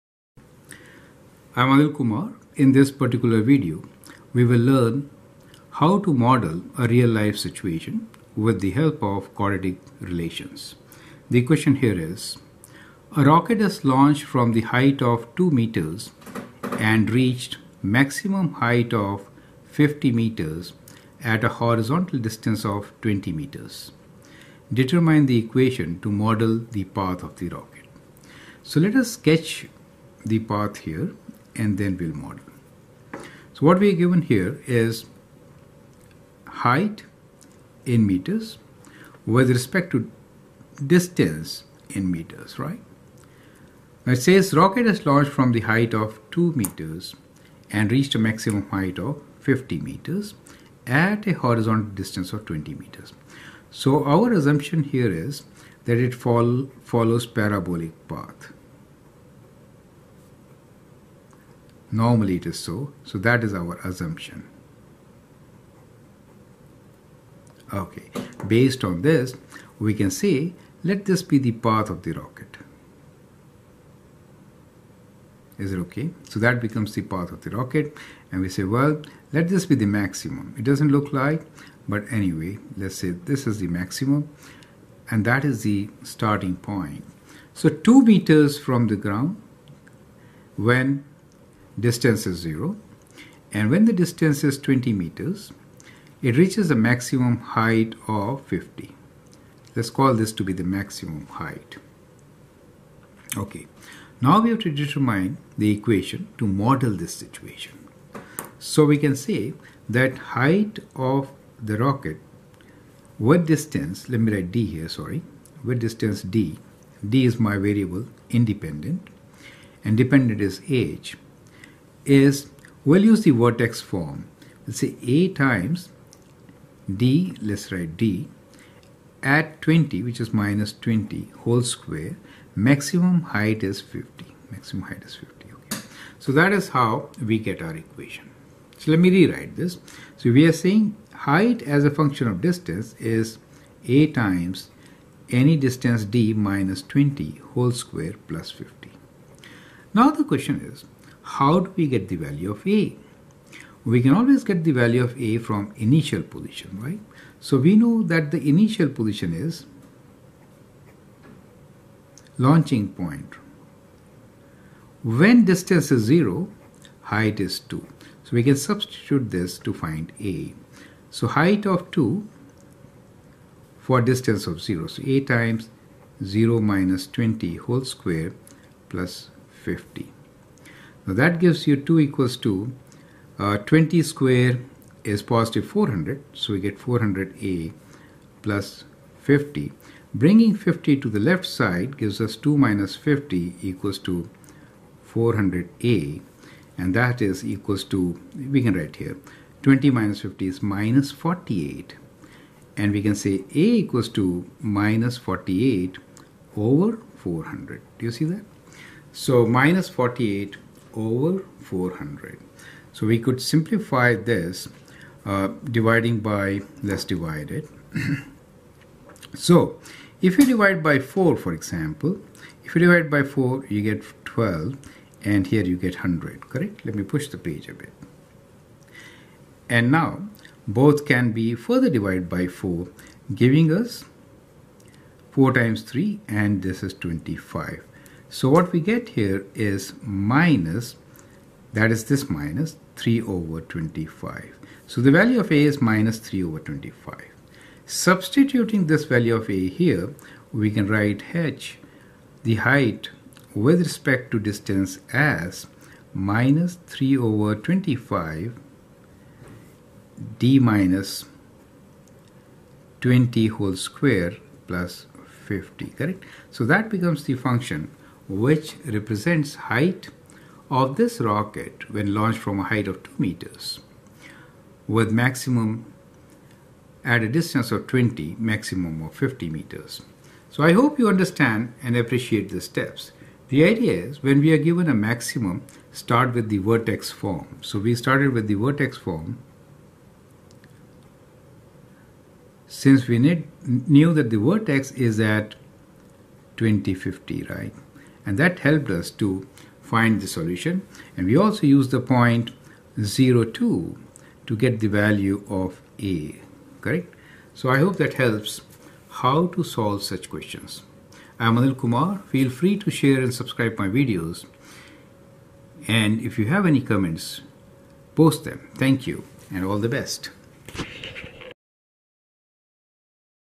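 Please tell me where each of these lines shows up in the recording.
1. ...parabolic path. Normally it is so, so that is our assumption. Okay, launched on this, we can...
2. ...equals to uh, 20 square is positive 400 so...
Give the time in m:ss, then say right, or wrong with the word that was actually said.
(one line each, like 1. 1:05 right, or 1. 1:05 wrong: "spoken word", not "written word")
1. 0:57 wrong: "based", not "launched"
2. 3:01 right.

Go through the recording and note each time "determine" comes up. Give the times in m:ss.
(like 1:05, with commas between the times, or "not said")
0:24, 1:44.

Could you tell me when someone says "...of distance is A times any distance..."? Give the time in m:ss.
2:22.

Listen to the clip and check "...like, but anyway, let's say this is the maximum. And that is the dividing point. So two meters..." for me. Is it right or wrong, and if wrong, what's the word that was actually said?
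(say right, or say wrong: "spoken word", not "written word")
wrong: "starting", not "dividing".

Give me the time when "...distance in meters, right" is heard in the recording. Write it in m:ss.
0:40.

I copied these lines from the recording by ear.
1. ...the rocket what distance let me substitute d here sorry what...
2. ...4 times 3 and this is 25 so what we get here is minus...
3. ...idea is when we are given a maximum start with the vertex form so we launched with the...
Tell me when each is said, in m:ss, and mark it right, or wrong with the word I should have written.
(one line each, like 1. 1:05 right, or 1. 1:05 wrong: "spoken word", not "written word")
1. 1:51 wrong: "write", not "substitute"
2. 3:55 right
3. 4:43 wrong: "started", not "launched".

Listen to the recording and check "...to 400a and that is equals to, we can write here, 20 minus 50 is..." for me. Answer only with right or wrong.
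right.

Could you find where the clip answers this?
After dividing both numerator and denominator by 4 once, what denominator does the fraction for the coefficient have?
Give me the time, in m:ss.
3:45.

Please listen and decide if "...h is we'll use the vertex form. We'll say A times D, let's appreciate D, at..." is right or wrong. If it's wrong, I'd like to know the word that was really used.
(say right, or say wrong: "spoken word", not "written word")
wrong: "write", not "appreciate".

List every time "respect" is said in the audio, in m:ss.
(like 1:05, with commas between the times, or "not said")
0:39, 4:13.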